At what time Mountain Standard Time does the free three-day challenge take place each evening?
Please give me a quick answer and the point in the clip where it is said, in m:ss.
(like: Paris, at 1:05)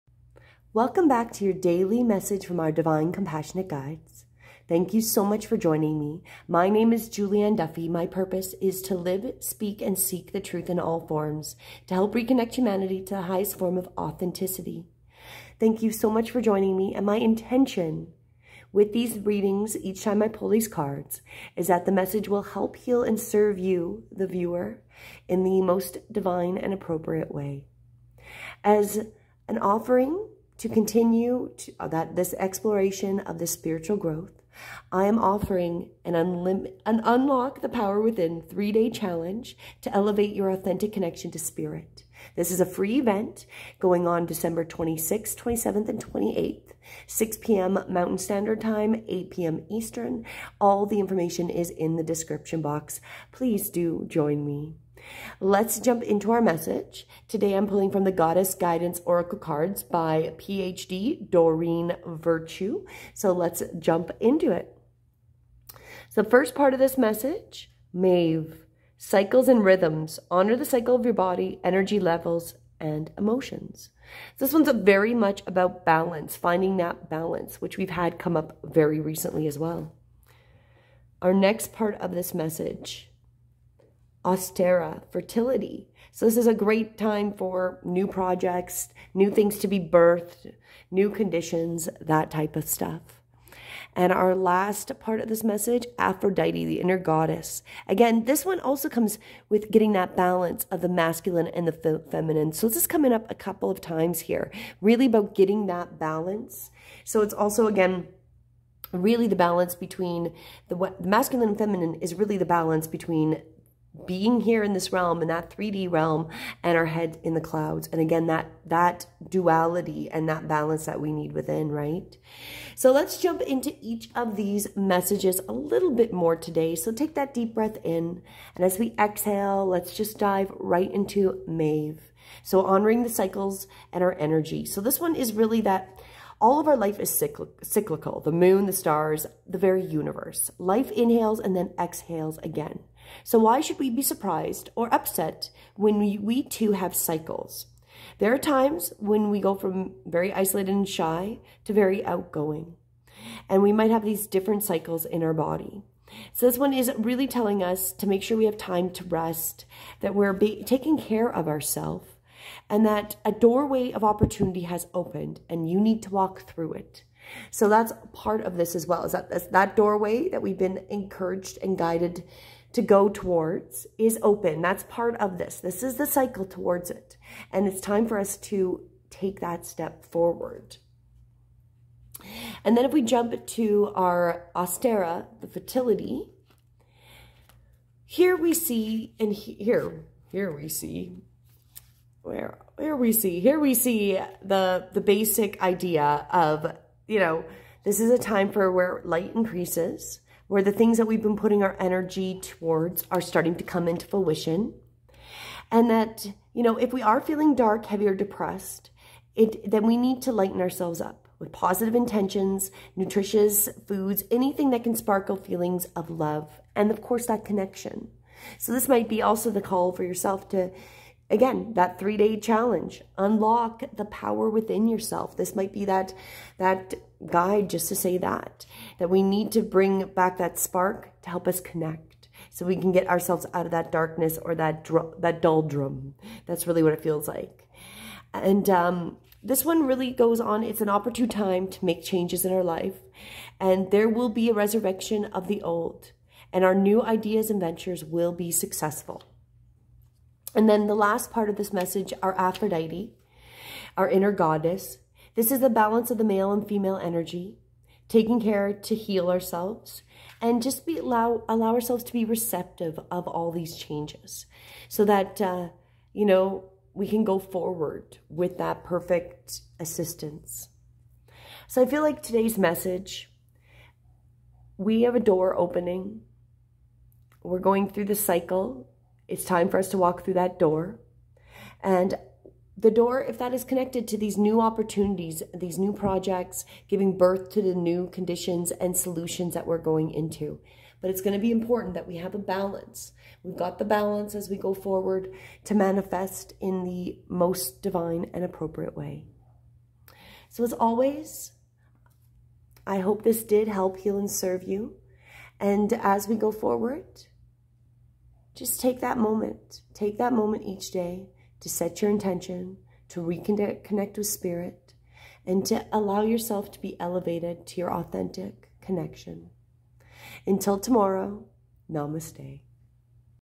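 6 p.m., at 0:47.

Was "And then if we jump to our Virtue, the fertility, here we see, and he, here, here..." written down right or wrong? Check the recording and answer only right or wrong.
wrong.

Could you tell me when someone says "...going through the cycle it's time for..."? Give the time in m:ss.
4:37.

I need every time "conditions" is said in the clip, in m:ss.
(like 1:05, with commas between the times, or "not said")
1:31, 4:48.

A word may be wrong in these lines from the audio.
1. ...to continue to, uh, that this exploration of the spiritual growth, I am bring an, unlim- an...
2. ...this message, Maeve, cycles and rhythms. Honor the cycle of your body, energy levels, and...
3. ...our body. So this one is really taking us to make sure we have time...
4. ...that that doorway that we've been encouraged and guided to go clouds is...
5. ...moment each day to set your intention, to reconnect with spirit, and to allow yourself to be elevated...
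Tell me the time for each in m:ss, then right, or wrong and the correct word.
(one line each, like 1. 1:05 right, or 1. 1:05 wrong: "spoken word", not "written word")
1. 0:30 wrong: "offering", not "bring"
2. 1:06 right
3. 2:35 wrong: "telling", not "taking"
4. 2:49 wrong: "towards", not "clouds"
5. 5:10 right.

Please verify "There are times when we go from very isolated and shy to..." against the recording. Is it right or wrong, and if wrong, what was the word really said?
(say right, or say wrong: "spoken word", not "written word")
right.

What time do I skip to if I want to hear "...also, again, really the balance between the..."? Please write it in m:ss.
1:47.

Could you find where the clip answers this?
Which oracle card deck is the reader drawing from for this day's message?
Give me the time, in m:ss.
0:58.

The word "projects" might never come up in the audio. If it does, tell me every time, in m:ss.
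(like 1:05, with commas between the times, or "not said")
1:28, 4:45.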